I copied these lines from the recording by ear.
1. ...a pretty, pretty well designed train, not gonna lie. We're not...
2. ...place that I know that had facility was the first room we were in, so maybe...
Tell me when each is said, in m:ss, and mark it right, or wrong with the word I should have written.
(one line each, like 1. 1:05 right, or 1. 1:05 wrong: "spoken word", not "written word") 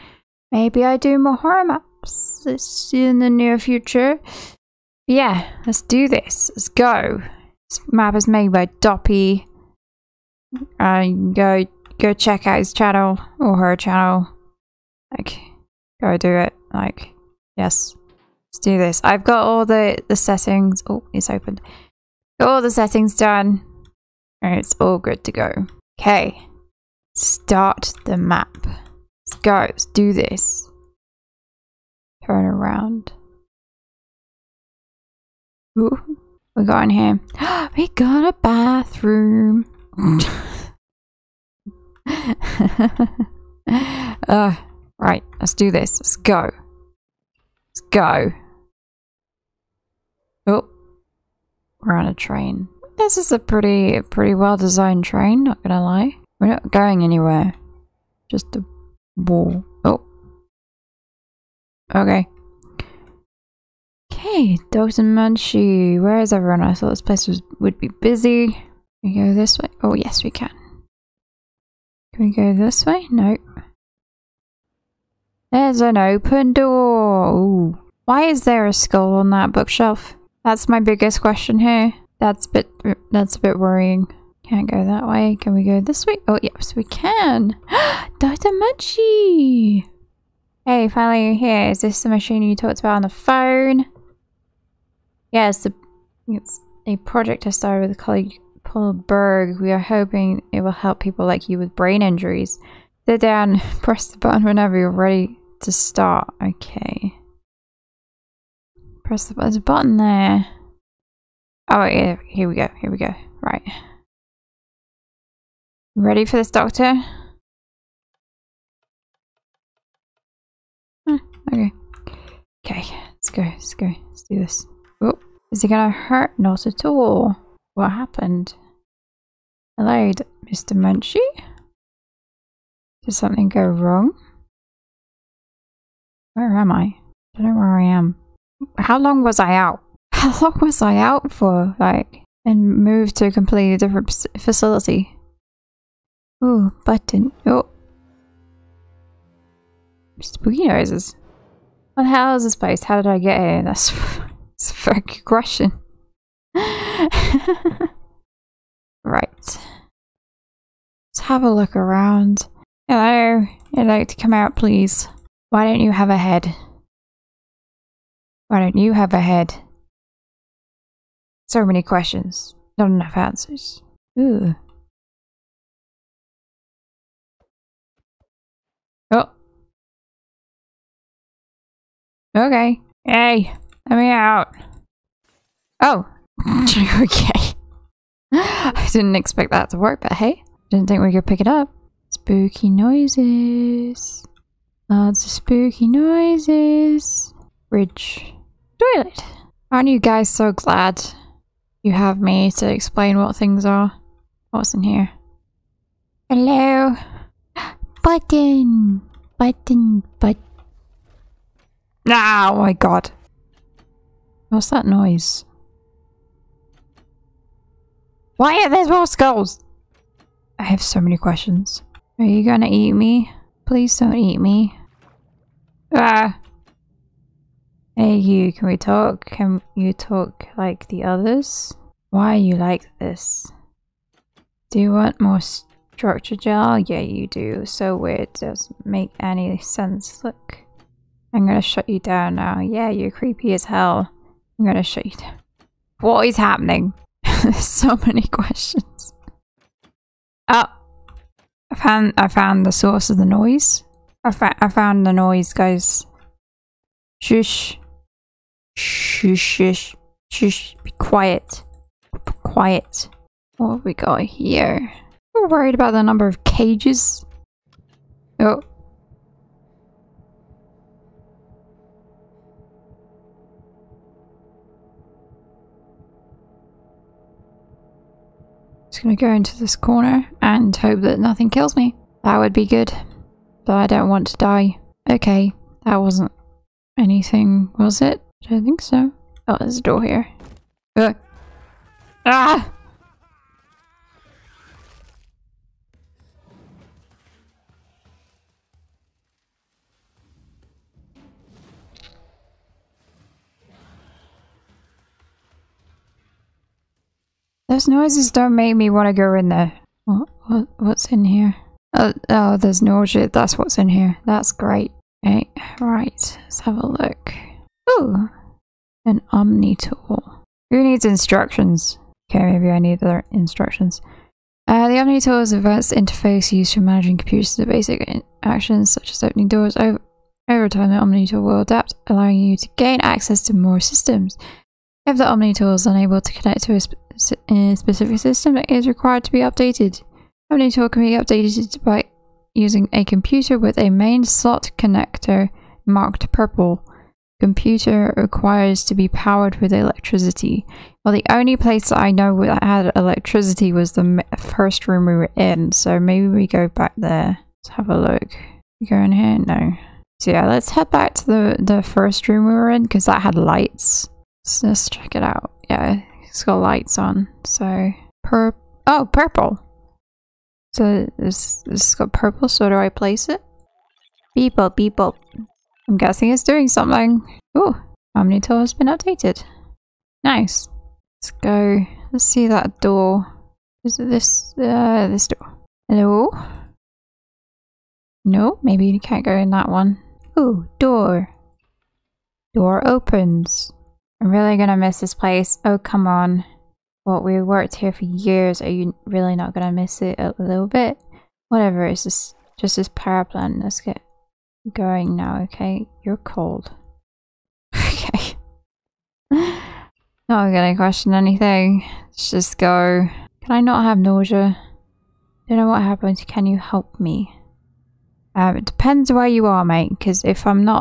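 1. 0:53 right
2. 5:51 wrong: "electricity", not "facility".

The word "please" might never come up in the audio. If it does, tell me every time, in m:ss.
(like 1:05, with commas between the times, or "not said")
2:44, 3:43.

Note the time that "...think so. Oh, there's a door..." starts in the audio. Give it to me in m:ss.
4:48.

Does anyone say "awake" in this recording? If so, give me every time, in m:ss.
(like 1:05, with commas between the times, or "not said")
not said.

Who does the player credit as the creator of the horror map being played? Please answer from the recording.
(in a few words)
Doppy.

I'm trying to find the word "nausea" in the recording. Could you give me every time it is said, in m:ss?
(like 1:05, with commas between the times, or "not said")
5:12, 6:53.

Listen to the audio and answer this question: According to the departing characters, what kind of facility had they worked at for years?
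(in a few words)
Power plant.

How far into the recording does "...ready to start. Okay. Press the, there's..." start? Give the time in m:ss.
1:44.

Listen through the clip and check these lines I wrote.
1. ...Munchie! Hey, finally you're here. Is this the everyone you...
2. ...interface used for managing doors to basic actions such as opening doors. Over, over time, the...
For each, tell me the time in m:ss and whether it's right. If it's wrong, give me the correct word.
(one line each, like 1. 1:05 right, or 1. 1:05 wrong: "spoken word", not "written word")
1. 1:28 wrong: "machine", not "everyone"
2. 5:25 wrong: "computers", not "doors".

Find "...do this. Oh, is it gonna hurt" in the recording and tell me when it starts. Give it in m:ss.
2:04.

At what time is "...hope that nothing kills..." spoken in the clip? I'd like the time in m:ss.
4:40.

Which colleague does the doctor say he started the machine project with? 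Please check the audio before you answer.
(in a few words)
Paul Berg.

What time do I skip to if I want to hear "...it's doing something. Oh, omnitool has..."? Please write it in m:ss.
6:16.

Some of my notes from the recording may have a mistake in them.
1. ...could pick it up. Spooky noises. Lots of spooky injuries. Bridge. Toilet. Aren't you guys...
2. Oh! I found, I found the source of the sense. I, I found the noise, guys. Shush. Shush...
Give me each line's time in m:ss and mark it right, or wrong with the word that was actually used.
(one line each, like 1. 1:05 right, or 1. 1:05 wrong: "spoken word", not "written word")
1. 3:11 wrong: "noises", not "injuries"
2. 4:10 wrong: "noise", not "sense".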